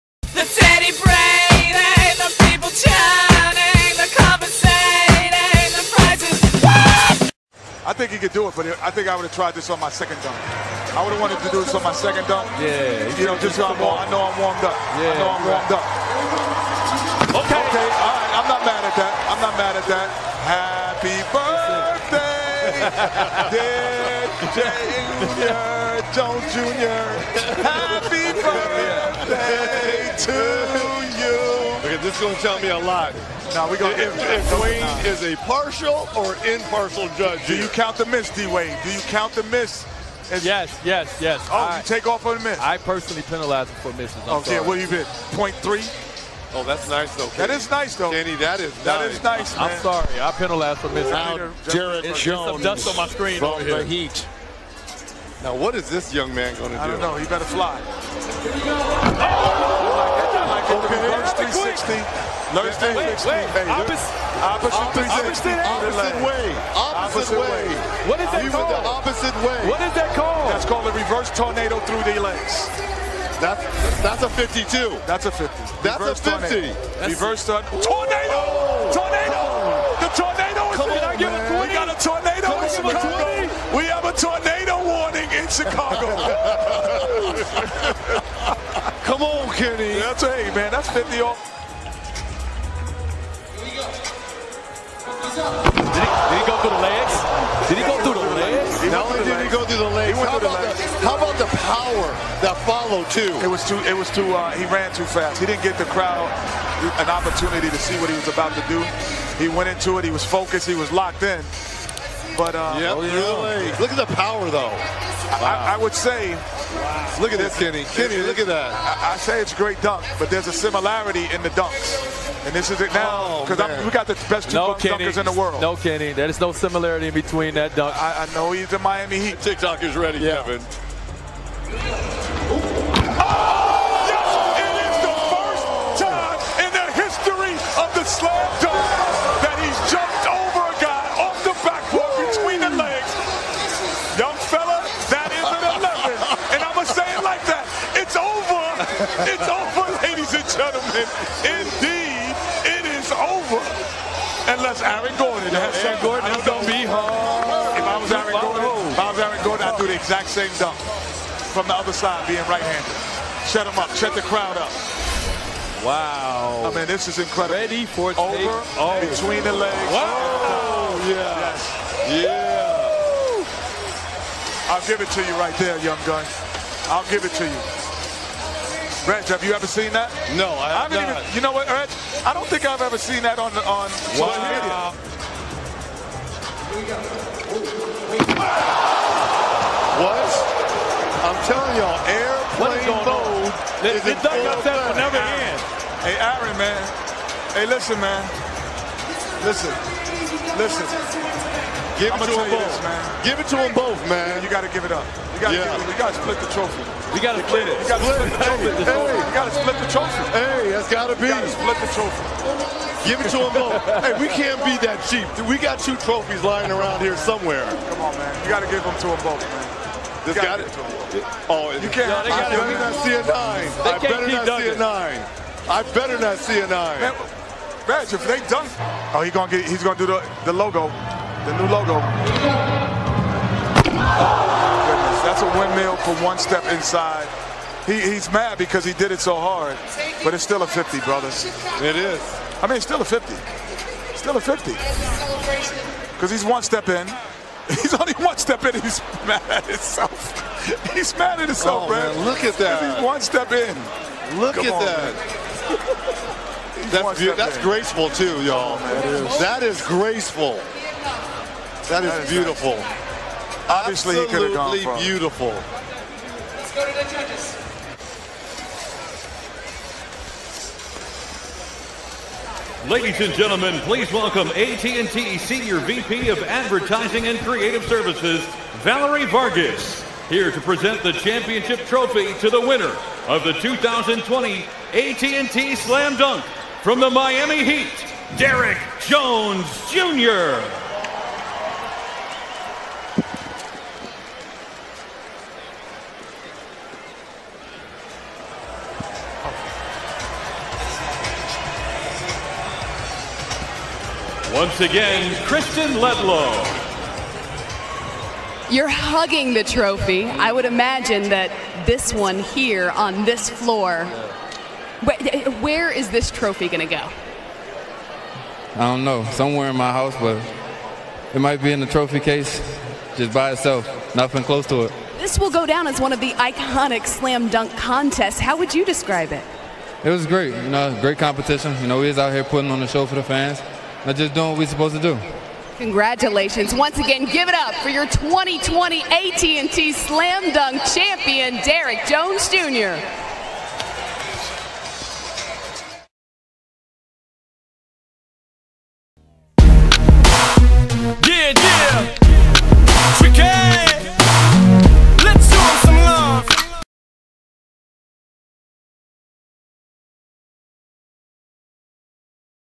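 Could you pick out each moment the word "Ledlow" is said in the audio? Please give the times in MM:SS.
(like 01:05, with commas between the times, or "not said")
05:05.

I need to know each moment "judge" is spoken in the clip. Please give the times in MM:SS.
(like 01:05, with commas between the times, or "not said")
00:37, 04:27.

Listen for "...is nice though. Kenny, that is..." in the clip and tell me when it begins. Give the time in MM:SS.
00:47.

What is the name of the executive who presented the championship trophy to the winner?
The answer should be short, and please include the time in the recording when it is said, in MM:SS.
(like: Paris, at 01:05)
Valerie Vargas, at 04:38.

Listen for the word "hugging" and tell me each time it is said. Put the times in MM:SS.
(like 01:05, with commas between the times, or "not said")
05:08.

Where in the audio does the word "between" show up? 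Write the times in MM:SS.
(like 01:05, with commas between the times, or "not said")
02:07, 02:49.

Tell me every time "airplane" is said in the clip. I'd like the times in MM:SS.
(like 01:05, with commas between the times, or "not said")
03:12.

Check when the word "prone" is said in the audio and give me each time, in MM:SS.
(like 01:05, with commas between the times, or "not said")
not said.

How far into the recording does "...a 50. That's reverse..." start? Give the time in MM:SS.
01:15.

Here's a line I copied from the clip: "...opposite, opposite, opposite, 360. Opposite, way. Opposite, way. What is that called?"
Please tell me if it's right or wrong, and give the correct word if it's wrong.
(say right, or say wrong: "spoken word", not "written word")
right.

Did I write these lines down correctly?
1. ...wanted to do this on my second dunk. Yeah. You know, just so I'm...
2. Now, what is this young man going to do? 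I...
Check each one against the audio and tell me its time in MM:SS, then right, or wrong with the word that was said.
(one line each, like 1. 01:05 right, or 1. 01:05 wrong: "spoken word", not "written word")
1. 00:11 right
2. 00:55 right.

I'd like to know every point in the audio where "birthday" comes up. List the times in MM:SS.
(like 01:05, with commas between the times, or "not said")
00:21, 00:28.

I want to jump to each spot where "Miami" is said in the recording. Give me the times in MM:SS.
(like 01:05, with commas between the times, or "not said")
02:08, 04:47.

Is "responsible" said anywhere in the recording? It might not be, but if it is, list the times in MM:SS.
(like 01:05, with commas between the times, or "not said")
not said.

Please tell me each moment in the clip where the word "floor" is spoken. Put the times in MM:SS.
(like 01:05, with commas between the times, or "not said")
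05:13.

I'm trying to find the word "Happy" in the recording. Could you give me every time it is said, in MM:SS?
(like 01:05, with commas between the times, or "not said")
00:21, 00:27.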